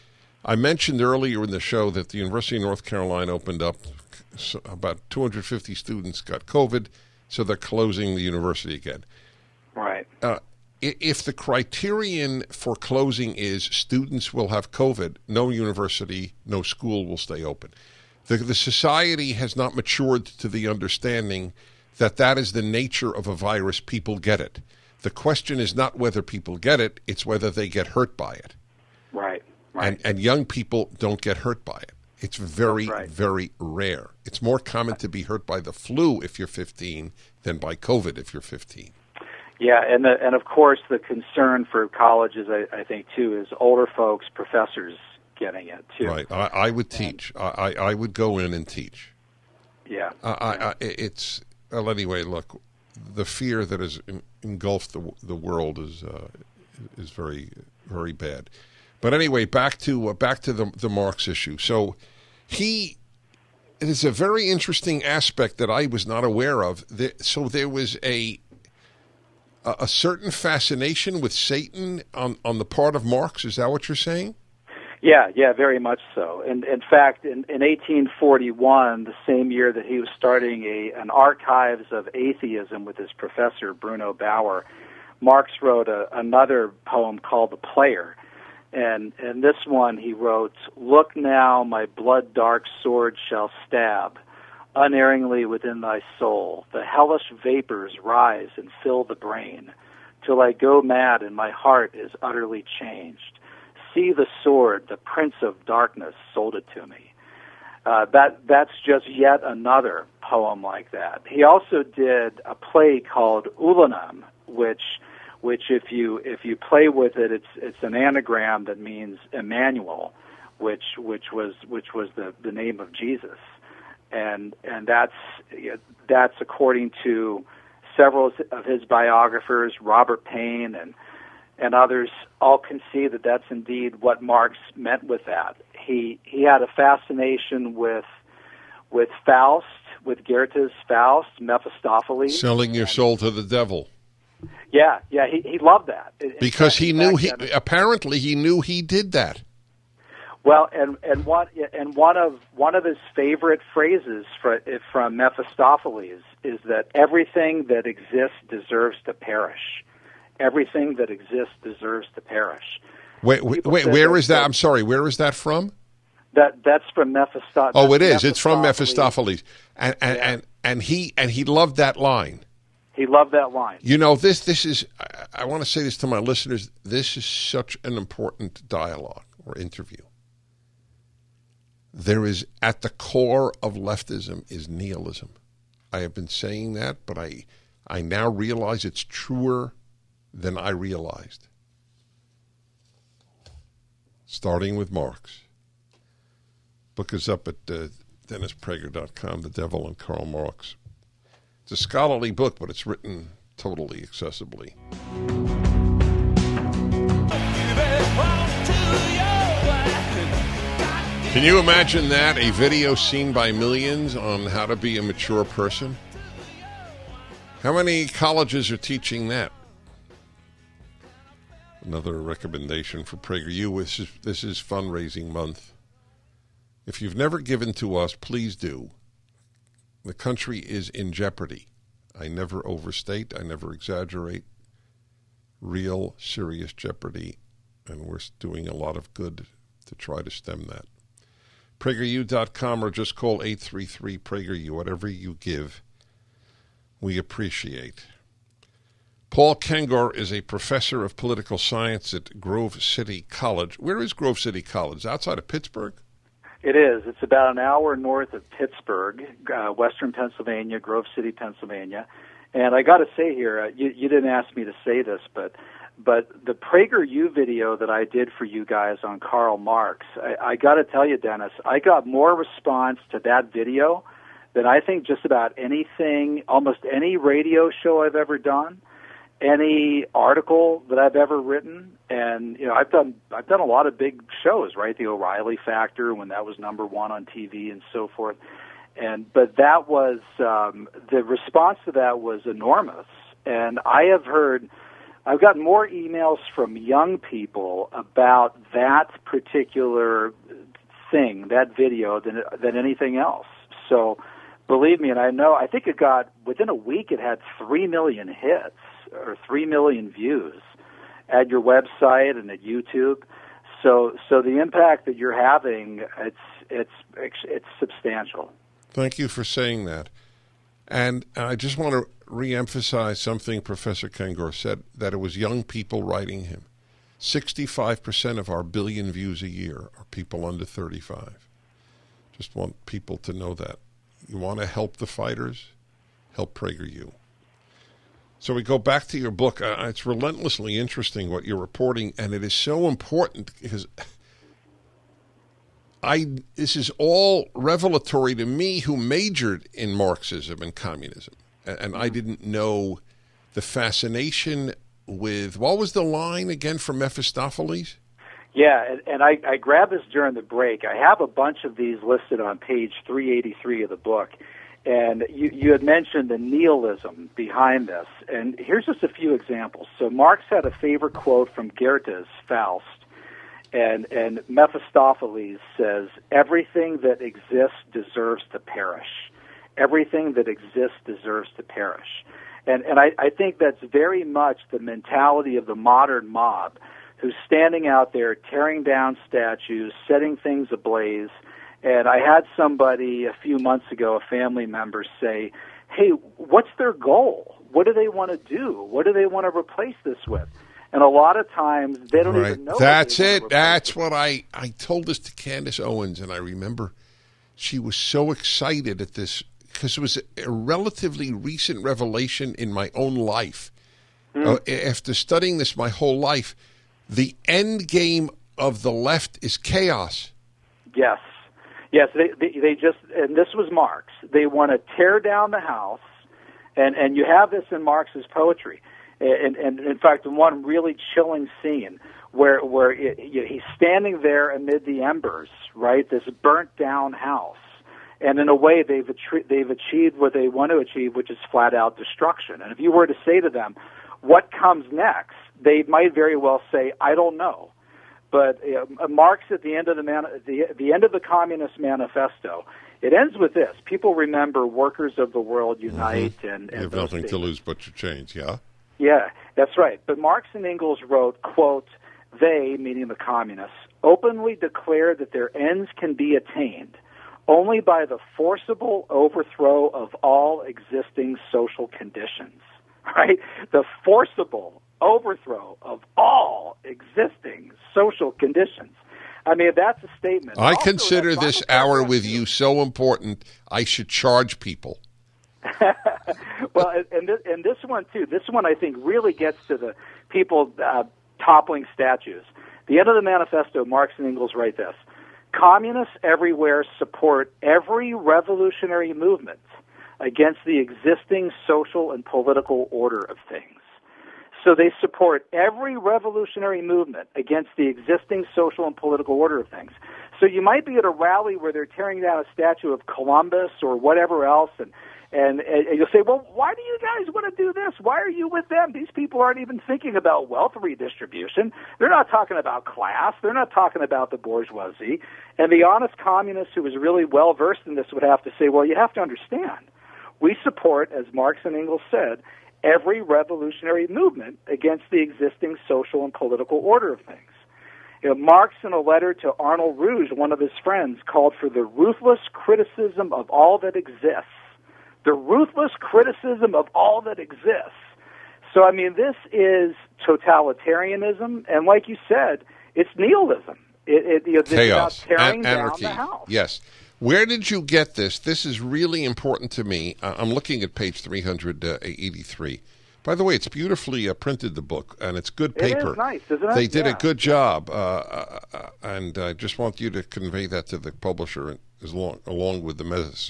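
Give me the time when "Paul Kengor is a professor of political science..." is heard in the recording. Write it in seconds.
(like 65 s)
249 s.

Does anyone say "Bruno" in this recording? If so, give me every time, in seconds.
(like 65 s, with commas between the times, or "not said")
83 s.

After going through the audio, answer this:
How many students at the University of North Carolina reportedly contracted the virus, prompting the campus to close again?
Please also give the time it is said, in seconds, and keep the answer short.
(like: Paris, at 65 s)
250, at 5 s.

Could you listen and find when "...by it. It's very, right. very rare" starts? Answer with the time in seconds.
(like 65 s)
31 s.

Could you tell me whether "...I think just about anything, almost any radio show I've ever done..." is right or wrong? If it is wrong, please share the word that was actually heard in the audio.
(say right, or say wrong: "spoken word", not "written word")
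right.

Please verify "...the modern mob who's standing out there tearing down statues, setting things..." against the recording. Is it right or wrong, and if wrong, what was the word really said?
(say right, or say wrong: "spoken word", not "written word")
right.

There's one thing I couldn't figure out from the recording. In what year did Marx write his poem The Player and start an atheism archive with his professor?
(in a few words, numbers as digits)
1841.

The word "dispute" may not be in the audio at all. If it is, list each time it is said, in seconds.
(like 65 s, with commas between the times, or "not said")
not said.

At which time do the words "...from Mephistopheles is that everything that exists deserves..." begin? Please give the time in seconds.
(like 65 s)
154 s.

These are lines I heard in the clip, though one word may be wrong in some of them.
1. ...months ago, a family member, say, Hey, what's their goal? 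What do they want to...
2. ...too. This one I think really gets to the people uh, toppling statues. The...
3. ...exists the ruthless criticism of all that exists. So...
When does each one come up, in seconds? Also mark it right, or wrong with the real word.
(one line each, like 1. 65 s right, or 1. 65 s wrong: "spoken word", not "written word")
1. 393 s right
2. 488 s right
3. 543 s right.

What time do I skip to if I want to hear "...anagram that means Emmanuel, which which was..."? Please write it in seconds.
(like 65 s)
117 s.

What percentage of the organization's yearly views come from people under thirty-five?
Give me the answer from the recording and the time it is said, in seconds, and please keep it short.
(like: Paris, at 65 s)
65%, at 327 s.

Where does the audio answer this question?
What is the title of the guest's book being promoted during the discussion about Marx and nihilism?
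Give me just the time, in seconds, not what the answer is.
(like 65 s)
199 s.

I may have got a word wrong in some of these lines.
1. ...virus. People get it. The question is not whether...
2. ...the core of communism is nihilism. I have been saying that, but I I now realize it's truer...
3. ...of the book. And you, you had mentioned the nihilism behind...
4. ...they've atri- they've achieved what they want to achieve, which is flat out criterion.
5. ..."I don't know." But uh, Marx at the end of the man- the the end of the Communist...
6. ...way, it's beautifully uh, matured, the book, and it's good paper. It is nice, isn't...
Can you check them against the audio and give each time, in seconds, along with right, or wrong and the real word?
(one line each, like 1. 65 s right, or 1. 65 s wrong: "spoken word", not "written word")
1. 23 s right
2. 182 s wrong: "leftism", not "communism"
3. 363 s right
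4. 438 s wrong: "destruction", not "criterion"
5. 446 s right
6. 563 s wrong: "printed", not "matured".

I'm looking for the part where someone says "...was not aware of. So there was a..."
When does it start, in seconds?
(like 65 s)
65 s.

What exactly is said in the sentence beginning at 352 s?
didn't know the fascination with what was the line again from Mephistopheles?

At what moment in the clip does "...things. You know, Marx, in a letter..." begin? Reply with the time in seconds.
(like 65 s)
537 s.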